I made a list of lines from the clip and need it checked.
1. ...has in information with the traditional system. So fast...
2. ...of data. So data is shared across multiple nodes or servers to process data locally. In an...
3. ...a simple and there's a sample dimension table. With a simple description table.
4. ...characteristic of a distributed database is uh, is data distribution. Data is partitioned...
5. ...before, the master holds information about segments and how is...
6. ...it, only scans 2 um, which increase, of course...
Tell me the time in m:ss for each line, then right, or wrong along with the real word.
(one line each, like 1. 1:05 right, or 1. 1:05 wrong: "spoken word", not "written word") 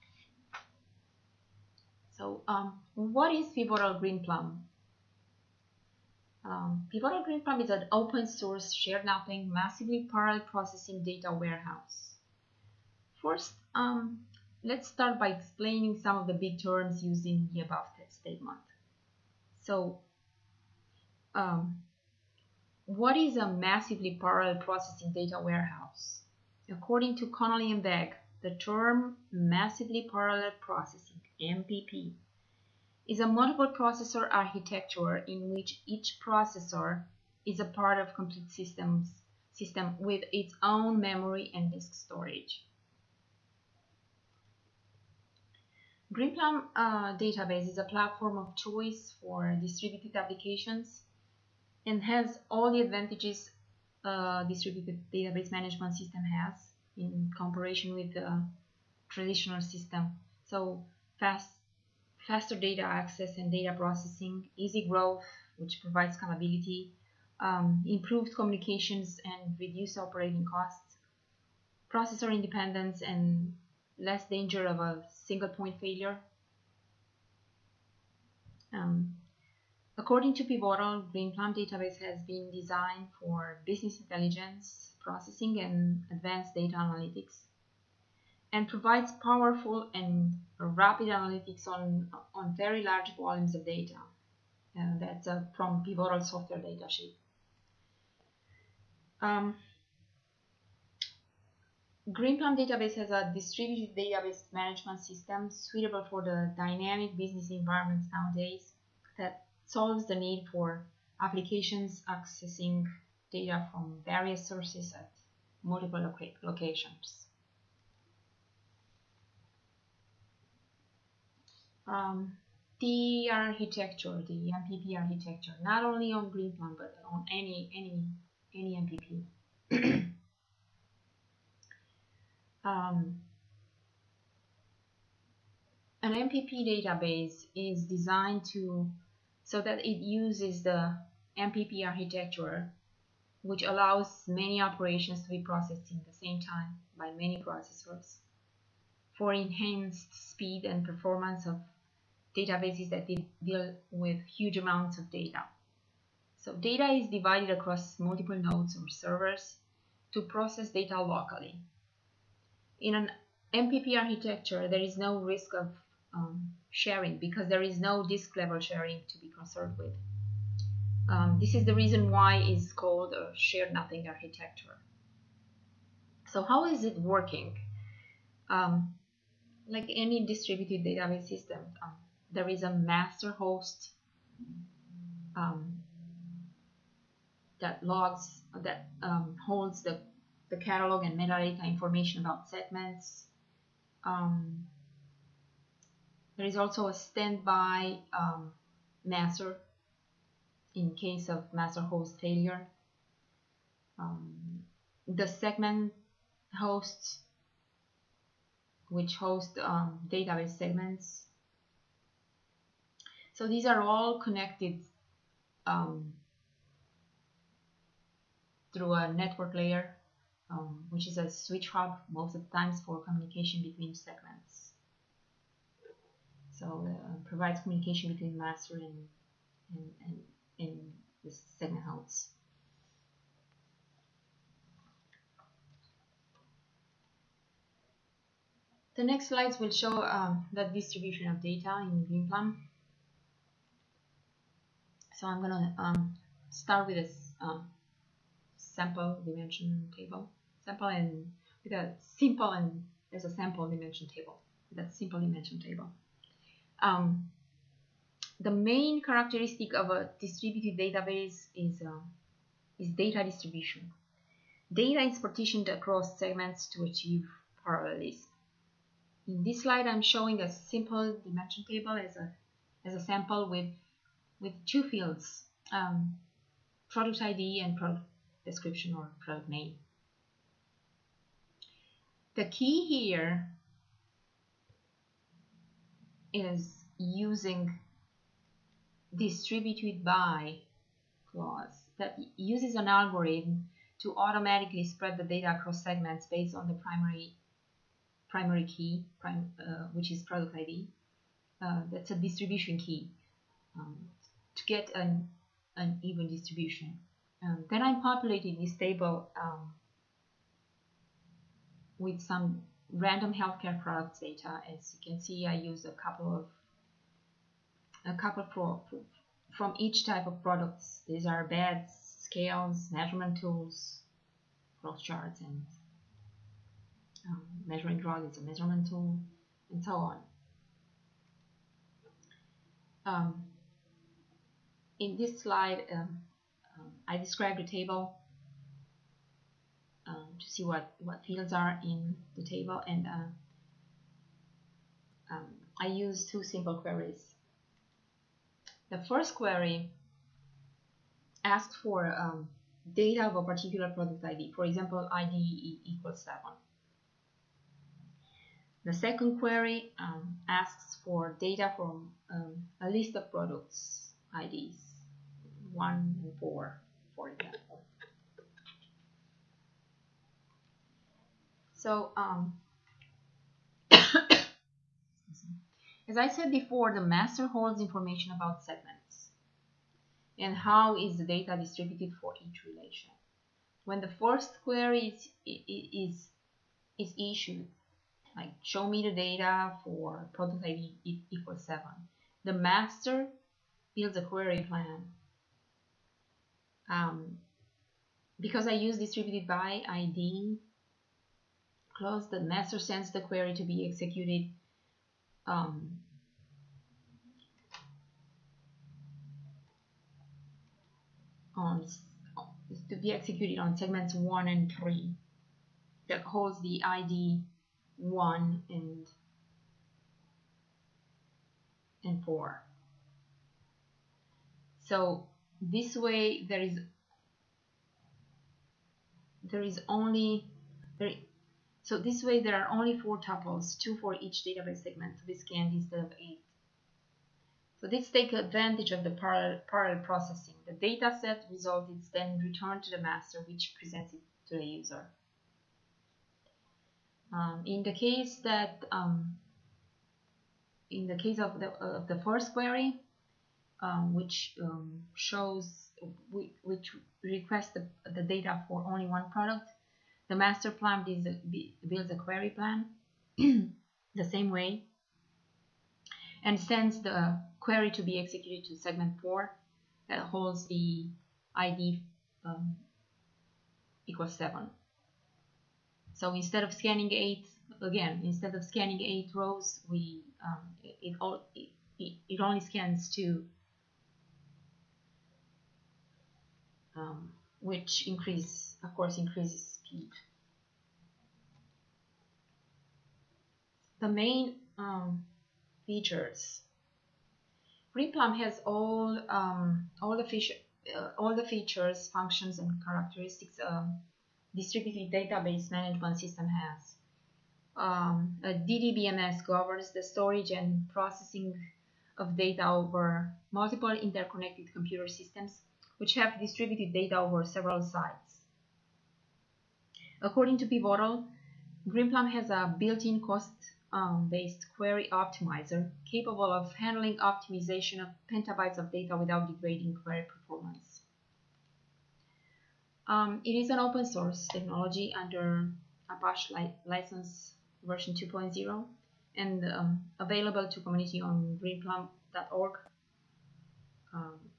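1. 0:56 wrong: "comparison", not "information"
2. 2:34 wrong: "divided", not "shared"
3. 4:11 wrong: "dimension", not "description"
4. 4:19 right
5. 6:16 right
6. 8:02 right.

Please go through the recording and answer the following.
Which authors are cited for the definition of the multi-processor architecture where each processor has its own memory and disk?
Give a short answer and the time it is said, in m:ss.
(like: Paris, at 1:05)
Connolly and Begg, at 0:27.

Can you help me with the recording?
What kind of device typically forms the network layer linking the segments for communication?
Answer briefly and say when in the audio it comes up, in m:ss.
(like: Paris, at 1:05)
switch hub, at 3:41.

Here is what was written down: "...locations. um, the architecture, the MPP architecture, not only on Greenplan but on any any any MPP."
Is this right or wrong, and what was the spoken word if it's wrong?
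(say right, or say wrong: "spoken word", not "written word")
right.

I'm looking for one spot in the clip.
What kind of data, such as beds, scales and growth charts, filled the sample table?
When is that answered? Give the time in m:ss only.
5:13.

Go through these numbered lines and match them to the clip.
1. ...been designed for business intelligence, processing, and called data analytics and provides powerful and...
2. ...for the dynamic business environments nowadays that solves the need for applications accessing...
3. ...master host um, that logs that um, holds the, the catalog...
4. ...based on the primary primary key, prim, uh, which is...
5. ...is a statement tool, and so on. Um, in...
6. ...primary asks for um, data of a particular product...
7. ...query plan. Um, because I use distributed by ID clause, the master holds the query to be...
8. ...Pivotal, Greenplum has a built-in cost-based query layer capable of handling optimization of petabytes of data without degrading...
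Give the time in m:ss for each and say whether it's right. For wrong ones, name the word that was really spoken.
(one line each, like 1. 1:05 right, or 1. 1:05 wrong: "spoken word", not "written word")
1. 1:22 wrong: "advanced", not "called"
2. 1:46 right
3. 3:02 right
4. 4:56 right
5. 5:28 wrong: "measurement", not "statement"
6. 5:49 wrong: "query", not "primary"
7. 6:34 wrong: "sends", not "holds"
8. 8:40 wrong: "optimizer", not "layer".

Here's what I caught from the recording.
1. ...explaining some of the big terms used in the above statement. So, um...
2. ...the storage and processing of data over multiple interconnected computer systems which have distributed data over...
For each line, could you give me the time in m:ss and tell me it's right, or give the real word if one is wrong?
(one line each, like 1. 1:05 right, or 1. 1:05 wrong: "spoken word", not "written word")
1. 0:15 right
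2. 8:29 right.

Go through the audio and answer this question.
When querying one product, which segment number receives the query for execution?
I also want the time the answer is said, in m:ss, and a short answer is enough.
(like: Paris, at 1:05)
segment 4, at 7:48.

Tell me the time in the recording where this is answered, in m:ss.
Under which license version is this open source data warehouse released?
8:56.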